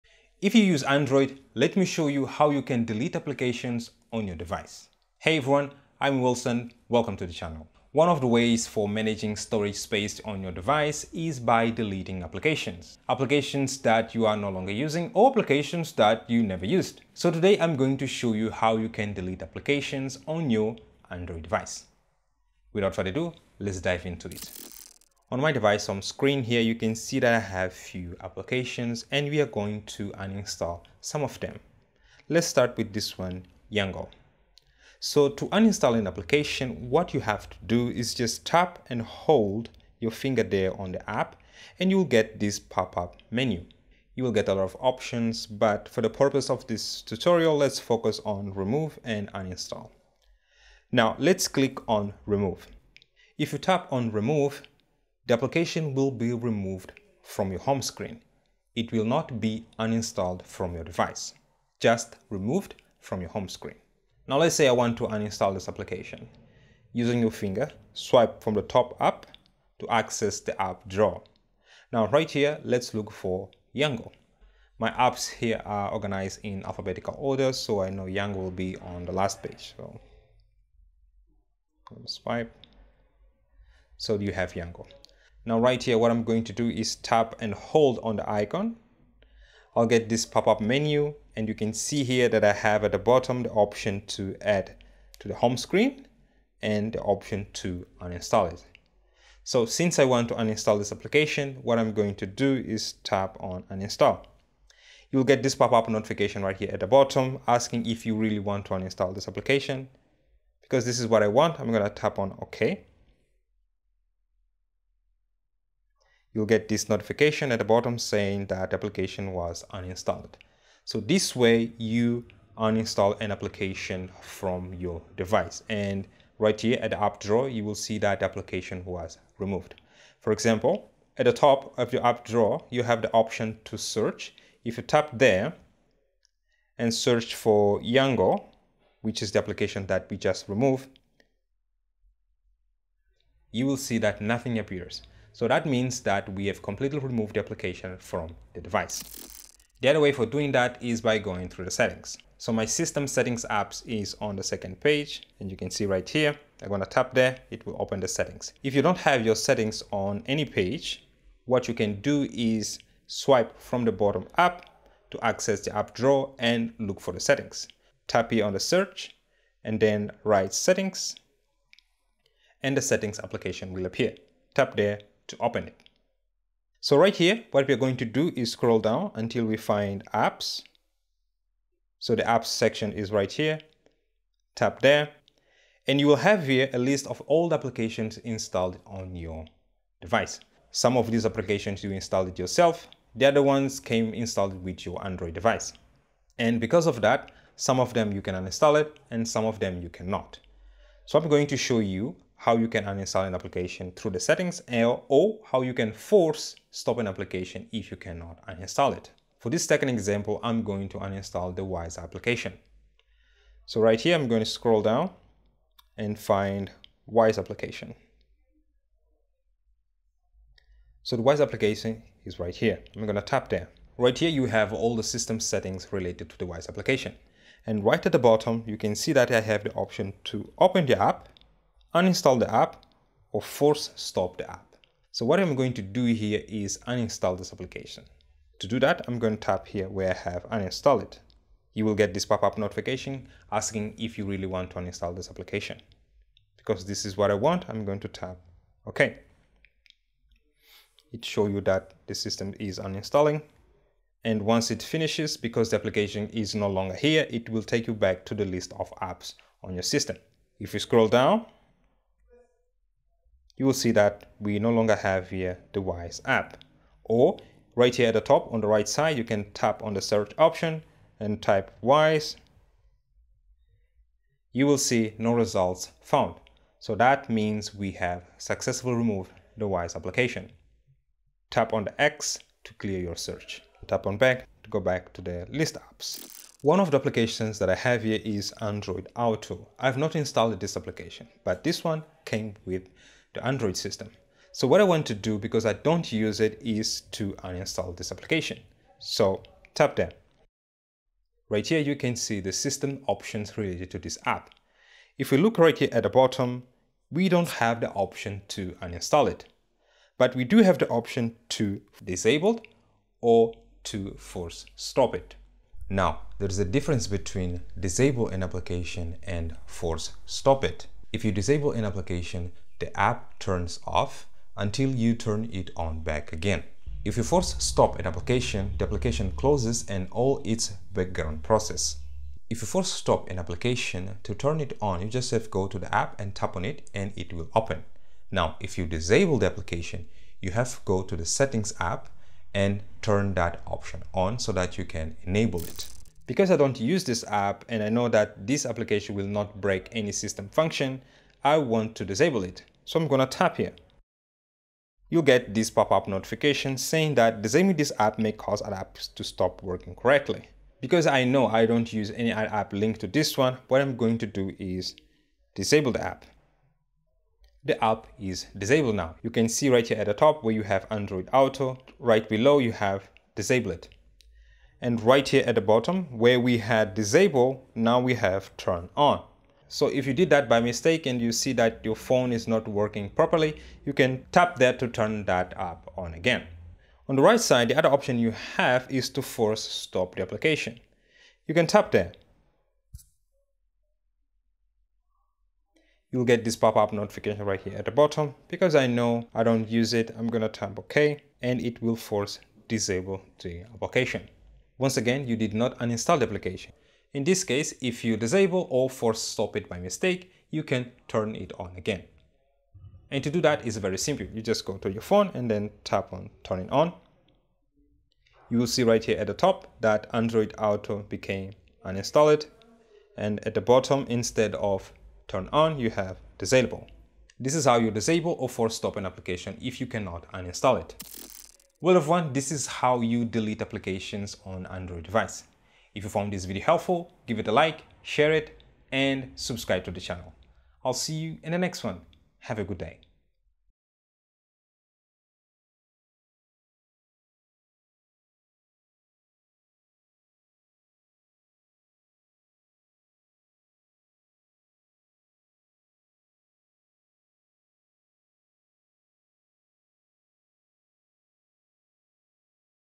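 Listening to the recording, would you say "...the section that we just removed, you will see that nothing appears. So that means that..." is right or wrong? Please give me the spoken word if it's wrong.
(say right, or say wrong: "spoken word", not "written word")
wrong: "application", not "section".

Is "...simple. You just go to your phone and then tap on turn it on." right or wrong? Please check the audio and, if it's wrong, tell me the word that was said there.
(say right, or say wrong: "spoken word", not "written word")
right.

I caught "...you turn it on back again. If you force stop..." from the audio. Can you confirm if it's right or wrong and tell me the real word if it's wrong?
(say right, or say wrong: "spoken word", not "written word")
right.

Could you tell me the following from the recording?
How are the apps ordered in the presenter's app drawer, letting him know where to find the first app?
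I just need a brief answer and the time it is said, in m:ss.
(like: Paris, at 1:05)
alphabetical order, at 1:16.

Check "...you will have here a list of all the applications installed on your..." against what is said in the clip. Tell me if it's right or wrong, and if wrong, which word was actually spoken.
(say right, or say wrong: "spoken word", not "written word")
right.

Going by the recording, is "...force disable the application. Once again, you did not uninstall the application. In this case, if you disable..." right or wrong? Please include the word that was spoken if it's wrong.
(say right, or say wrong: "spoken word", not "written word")
right.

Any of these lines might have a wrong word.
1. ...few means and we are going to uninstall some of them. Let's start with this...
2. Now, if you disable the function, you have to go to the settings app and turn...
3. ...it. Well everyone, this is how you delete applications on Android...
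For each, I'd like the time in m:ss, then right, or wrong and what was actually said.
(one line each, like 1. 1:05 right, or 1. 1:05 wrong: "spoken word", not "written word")
1. 0:27 wrong: "applications", not "means"
2. 5:38 wrong: "application", not "function"
3. 7:10 right.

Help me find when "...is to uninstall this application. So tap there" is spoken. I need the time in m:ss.
4:56.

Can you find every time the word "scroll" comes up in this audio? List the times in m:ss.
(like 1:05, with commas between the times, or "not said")
2:58, 3:34, 4:20.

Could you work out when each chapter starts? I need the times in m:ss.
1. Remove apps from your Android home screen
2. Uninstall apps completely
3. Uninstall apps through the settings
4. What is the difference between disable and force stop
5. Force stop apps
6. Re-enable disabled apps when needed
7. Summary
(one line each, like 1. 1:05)
1. 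0:24
2. 1:03
3. 2:29
4. 5:17
5. 6:25
6. 6:45
7. 7:12.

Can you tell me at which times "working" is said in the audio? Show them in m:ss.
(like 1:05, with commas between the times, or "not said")
5:59, 6:22.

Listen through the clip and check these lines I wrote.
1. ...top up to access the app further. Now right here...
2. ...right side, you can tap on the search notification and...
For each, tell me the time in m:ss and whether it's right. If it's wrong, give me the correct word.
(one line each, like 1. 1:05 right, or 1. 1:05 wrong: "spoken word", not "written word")
1. 1:08 wrong: "drawer", not "further"
2. 4:28 wrong: "option", not "notification".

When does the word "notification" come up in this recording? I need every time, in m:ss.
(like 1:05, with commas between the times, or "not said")
1:45, 1:56, 4:02, 5:56, 6:36.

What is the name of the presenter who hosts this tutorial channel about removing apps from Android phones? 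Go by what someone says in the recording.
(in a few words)
Wilson.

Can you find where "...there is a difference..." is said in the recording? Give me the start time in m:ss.
5:16.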